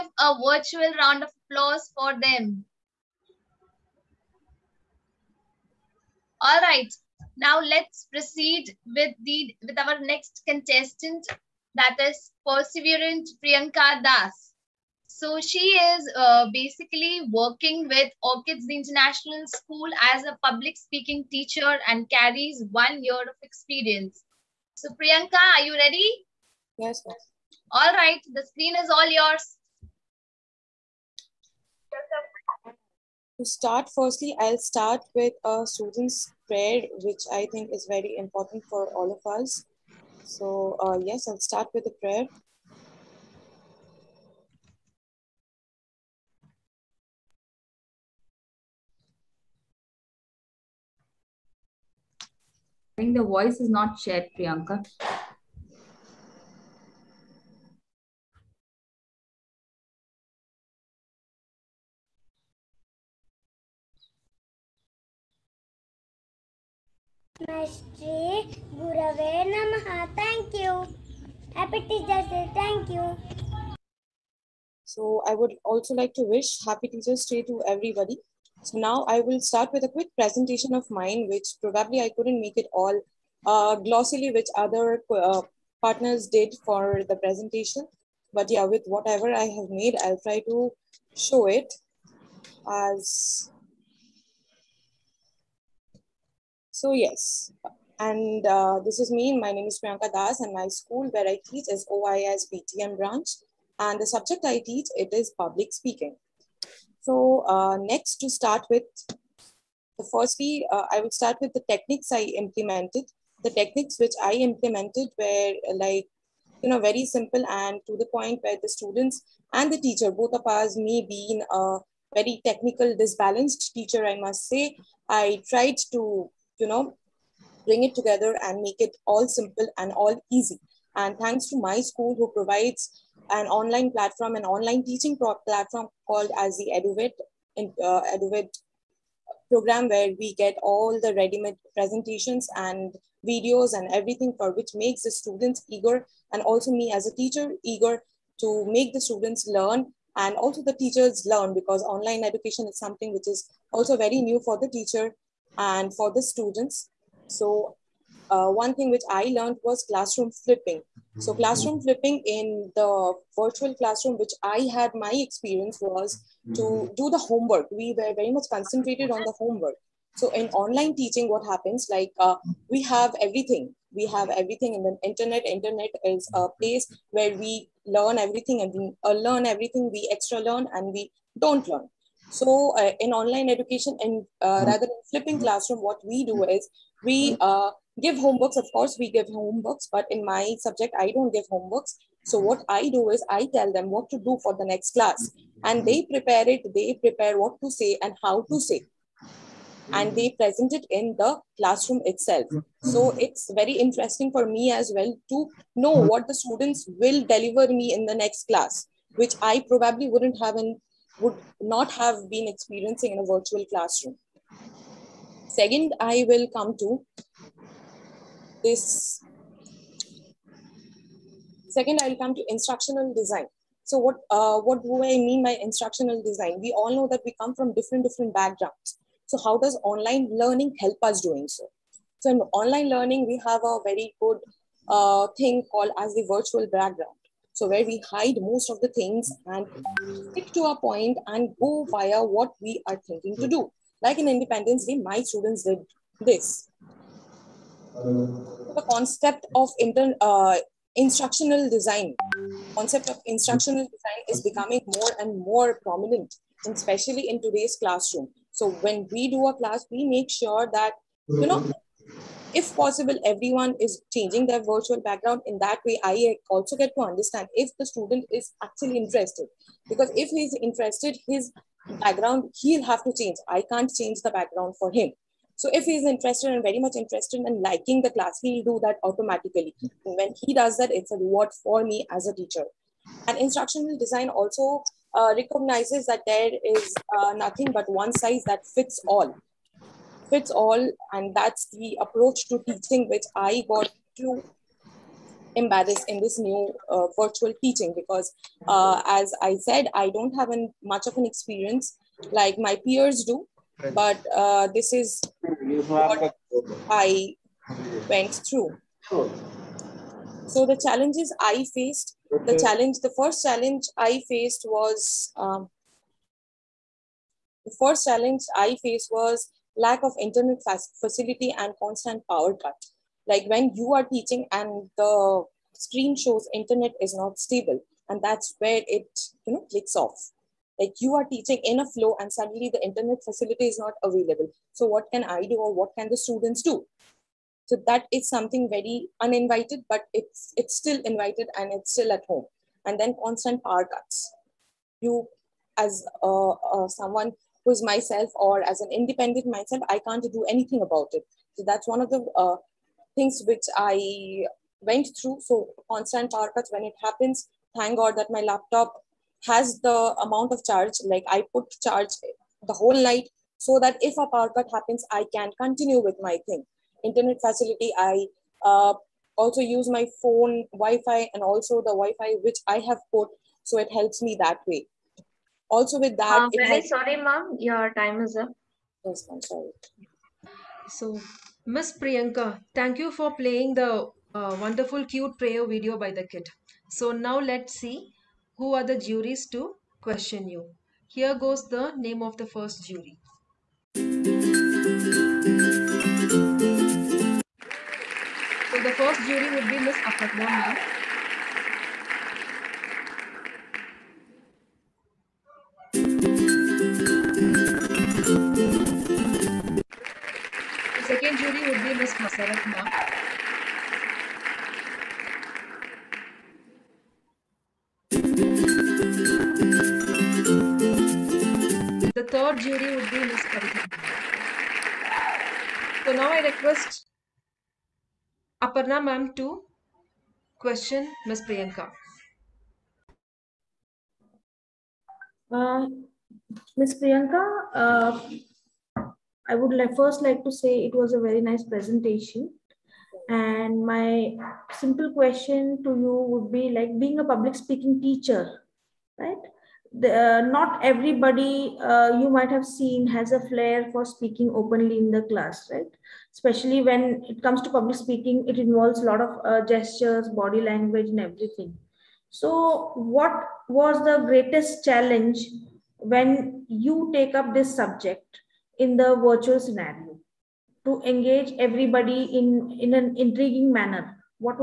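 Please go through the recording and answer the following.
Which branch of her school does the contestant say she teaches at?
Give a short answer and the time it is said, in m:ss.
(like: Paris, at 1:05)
BTM, at 1:41.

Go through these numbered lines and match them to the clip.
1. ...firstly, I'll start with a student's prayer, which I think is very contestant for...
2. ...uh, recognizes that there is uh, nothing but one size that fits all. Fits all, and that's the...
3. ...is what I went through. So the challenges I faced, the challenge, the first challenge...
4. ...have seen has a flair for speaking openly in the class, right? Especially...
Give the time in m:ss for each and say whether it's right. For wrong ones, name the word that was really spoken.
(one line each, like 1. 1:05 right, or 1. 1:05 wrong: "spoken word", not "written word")
1. 0:33 wrong: "important", not "contestant"
2. 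4:45 right
3. 5:04 right
4. 7:32 right.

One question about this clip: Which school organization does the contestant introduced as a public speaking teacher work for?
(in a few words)
Orchids International School.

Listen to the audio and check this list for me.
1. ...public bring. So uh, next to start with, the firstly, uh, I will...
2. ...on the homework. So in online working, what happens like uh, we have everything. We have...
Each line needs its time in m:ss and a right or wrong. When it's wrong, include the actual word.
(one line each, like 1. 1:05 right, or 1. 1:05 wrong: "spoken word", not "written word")
1. 1:45 wrong: "speaking", not "bring"
2. 2:49 wrong: "teaching", not "working".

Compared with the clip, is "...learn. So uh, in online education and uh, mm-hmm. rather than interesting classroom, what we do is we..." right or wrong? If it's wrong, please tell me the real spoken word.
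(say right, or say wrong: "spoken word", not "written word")
wrong: "flipping", not "interesting".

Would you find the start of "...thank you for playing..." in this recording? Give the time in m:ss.
6:22.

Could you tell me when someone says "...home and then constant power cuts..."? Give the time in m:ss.
5:42.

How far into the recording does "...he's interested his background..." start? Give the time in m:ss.
4:30.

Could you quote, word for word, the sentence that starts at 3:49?
So how does online learning help us doing so?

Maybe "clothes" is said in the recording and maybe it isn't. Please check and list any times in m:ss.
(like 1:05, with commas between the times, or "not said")
not said.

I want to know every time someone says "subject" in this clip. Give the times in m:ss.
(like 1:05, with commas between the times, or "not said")
1:44, 3:10, 7:47.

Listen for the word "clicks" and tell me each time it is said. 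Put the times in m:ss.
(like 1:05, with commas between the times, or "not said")
5:29.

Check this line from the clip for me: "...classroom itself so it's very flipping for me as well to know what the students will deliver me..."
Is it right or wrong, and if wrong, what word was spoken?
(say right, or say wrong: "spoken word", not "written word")
wrong: "interesting", not "flipping".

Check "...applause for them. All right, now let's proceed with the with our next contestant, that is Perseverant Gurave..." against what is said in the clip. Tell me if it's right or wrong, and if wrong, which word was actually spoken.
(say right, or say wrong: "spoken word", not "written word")
wrong: "Priyanka", not "Gurave".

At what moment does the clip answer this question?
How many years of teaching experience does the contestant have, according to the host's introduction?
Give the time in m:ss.
0:22.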